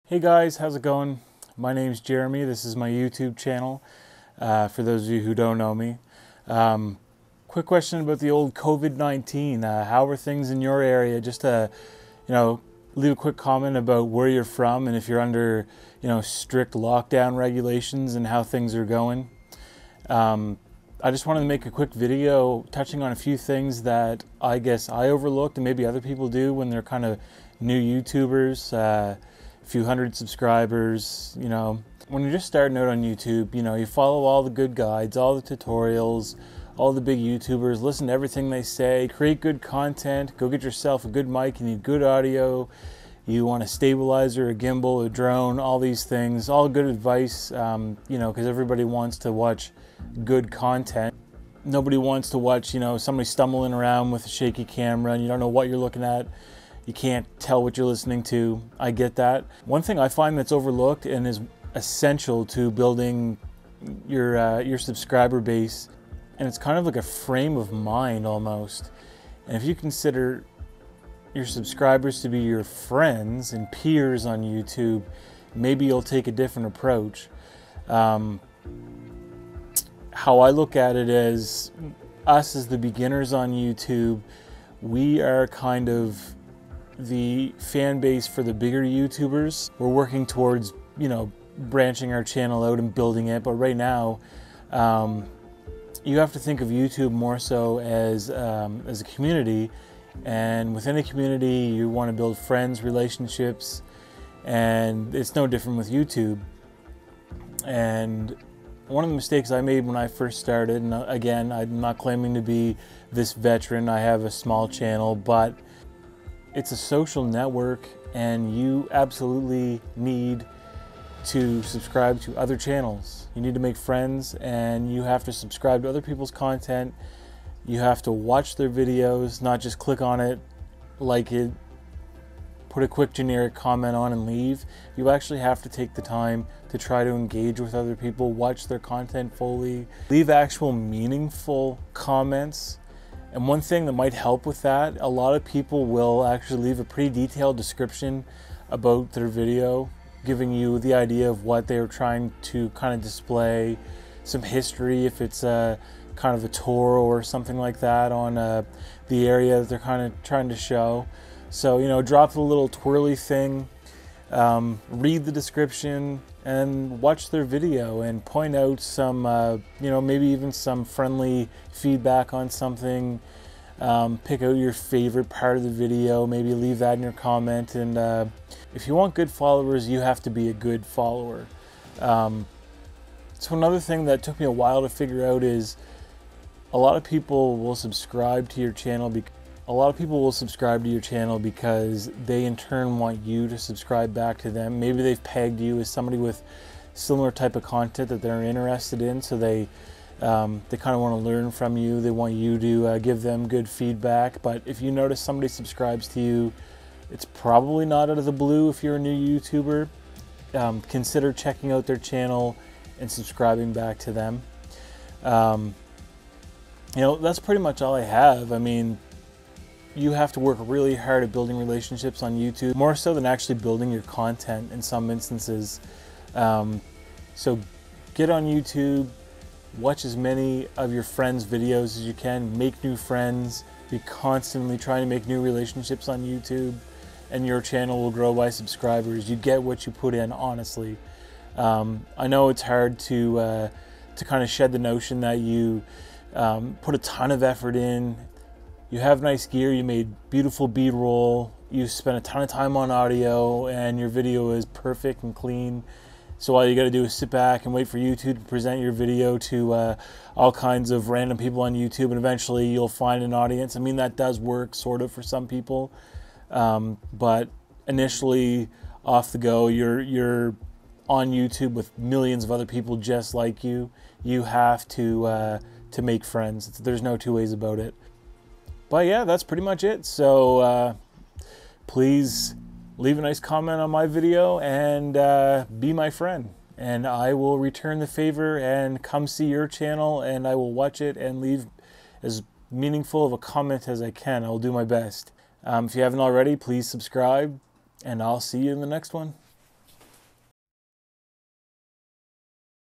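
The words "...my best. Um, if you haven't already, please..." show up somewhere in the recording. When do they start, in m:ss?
4:54.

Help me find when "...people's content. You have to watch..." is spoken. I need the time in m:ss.
2:06.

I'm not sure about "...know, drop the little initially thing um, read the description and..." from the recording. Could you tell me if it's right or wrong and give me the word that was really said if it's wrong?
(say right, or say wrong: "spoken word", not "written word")
wrong: "twirly", not "initially".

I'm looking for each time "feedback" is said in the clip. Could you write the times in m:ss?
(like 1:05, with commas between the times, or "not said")
2:51, 3:23.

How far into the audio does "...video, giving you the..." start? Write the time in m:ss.
2:29.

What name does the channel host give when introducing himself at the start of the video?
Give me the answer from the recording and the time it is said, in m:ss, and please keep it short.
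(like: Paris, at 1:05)
Jeremy, at 0:02.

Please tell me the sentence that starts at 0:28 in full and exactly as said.
Uh, few hundred subscribers, you know.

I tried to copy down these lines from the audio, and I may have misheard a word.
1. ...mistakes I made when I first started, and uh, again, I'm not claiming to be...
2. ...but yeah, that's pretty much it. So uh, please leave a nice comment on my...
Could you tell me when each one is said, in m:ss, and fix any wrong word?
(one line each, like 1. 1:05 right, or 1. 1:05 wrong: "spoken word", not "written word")
1. 1:49 right
2. 4:38 right.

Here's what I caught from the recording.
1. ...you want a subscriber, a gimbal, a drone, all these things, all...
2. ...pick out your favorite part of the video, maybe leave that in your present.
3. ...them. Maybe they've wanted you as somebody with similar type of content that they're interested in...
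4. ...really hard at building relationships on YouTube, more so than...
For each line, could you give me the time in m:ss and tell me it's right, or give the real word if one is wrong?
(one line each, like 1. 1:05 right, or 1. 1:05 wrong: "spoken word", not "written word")
1. 0:43 wrong: "stabilizer", not "subscriber"
2. 2:54 wrong: "comment", not "present"
3. 3:14 wrong: "pegged", not "wanted"
4. 3:40 right.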